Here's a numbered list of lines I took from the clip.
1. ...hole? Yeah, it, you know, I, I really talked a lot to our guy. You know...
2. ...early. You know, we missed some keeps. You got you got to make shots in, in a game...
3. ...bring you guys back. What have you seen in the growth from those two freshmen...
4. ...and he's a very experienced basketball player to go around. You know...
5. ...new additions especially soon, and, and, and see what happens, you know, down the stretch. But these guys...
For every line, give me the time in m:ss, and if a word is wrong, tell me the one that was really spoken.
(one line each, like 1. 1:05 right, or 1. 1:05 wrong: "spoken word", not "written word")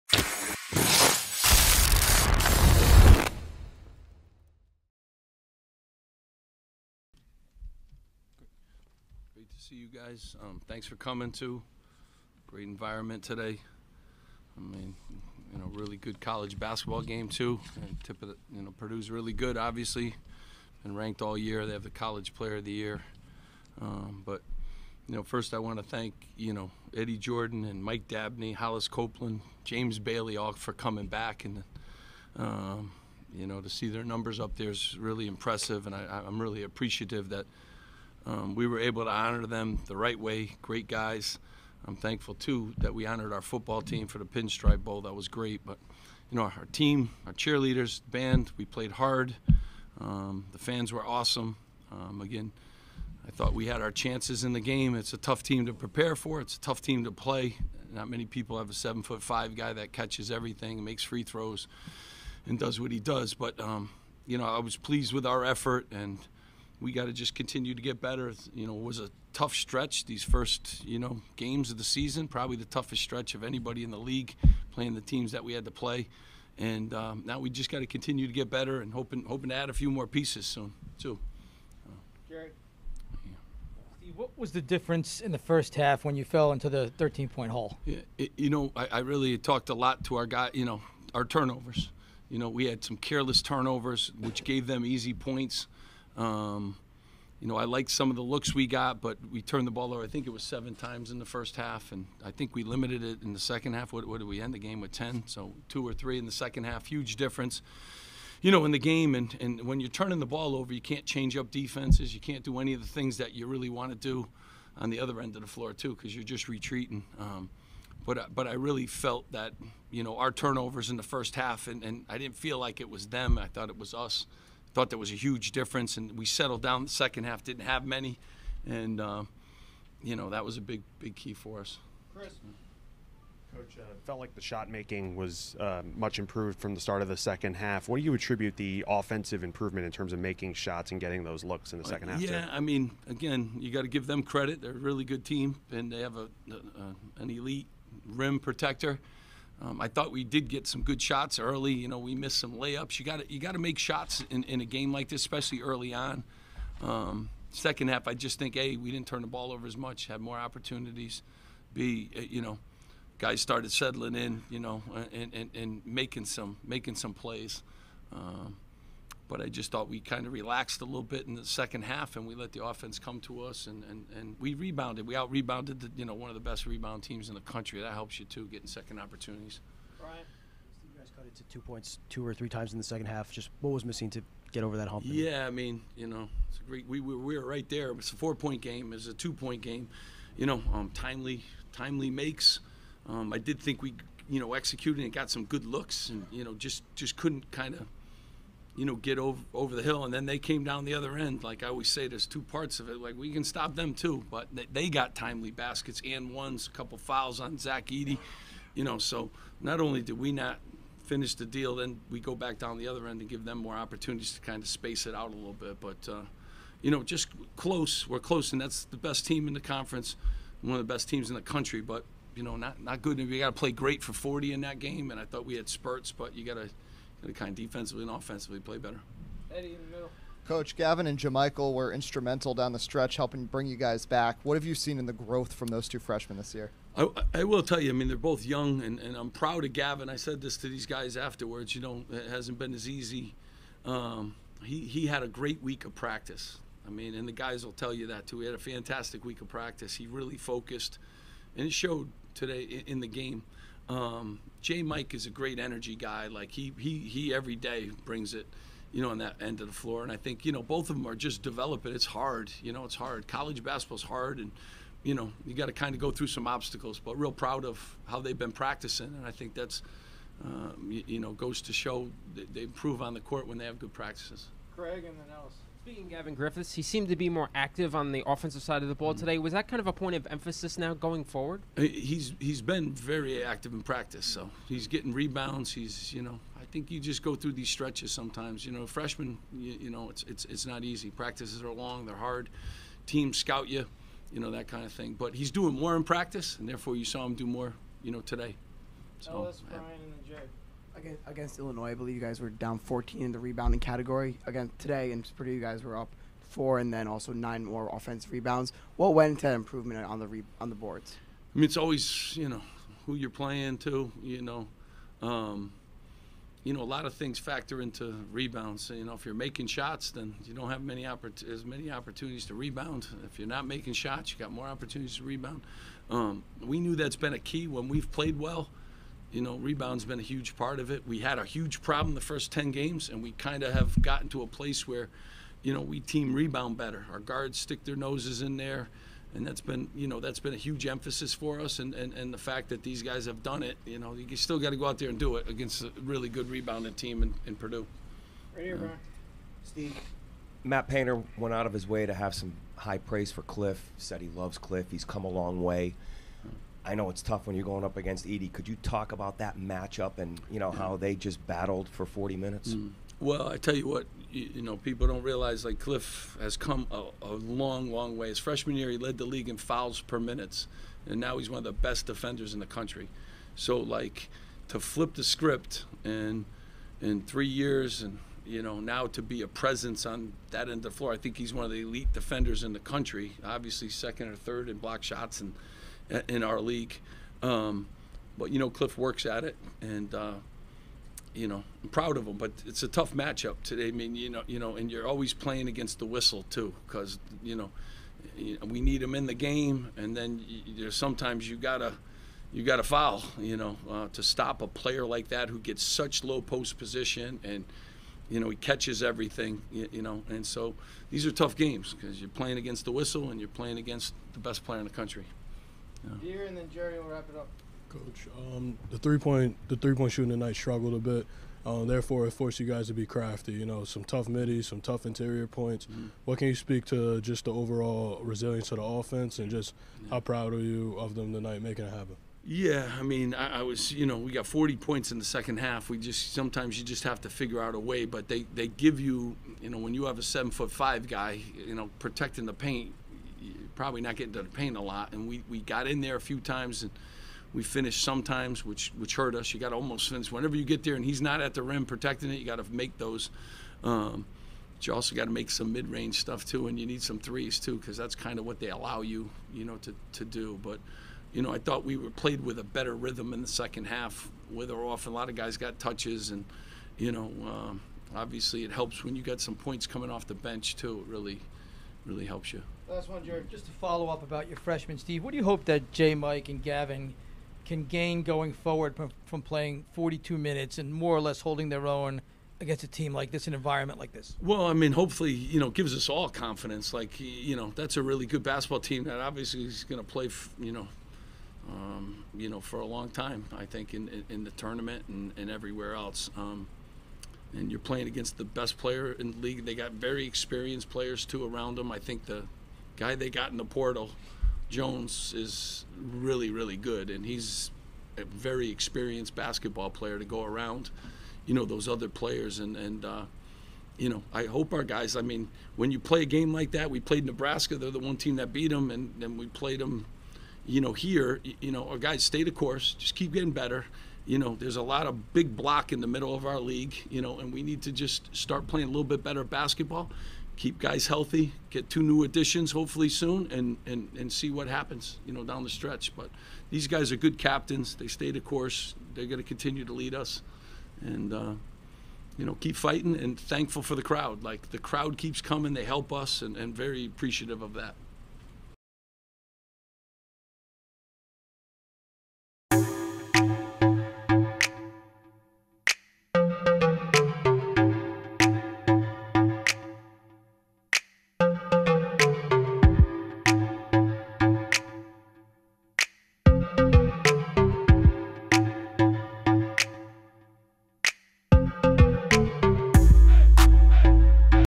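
1. 1:27 right
2. 2:31 wrong: "layups", not "keeps"
3. 3:53 right
4. 8:27 right
5. 8:52 wrong: "hopefully", not "especially".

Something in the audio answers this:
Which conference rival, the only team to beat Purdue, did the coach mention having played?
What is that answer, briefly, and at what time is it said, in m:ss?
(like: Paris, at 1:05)
Nebraska, at 8:37.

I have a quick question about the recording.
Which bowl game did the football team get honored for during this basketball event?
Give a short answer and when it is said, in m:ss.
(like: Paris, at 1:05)
Pinstripe Bowl, at 0:44.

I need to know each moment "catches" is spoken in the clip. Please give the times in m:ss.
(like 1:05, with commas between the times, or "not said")
0:59, 6:48.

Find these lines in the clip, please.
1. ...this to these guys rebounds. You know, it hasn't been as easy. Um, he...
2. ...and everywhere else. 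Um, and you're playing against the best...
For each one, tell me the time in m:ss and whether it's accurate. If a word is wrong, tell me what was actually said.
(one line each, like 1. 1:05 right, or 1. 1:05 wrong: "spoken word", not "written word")
1. 4:00 wrong: "afterwards", not "rebounds"
2. 8:15 right.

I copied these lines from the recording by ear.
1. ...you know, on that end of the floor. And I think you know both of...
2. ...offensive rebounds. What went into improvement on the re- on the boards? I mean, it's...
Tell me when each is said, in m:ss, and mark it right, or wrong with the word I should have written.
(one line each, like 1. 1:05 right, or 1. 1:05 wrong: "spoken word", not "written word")
1. 4:18 right
2. 5:07 right.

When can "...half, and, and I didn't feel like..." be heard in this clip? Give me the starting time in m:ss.
2:01.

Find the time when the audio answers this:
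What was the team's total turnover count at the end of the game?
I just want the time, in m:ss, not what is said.
1:44.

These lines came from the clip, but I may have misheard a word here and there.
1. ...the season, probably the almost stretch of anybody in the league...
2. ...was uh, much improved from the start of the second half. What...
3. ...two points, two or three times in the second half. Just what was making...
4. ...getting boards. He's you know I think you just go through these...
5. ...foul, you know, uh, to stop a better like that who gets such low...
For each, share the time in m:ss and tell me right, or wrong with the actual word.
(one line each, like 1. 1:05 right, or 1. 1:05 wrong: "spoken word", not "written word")
1. 1:11 wrong: "toughest", not "almost"
2. 2:15 right
3. 3:01 wrong: "missing", not "making"
4. 4:44 wrong: "rebounds", not "boards"
5. 6:42 wrong: "player", not "better".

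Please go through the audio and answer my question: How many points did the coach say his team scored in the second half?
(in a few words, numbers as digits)
40.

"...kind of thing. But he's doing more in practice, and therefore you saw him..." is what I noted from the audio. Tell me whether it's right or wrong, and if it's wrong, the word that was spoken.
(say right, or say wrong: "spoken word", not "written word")
right.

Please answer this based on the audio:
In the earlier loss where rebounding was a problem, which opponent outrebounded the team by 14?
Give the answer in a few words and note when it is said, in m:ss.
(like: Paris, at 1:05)
Illinois, at 5:01.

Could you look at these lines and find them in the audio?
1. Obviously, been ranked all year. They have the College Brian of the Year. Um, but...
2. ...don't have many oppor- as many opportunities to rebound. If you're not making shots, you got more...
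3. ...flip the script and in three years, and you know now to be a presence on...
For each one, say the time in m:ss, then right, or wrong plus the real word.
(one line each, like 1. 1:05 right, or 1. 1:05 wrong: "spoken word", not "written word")
1. 0:19 wrong: "Player", not "Brian"
2. 5:20 right
3. 6:14 right.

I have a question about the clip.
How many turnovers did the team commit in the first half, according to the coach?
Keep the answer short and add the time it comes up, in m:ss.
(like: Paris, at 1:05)
7, at 1:40.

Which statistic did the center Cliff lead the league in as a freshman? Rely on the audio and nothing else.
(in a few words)
Fouls per minutes.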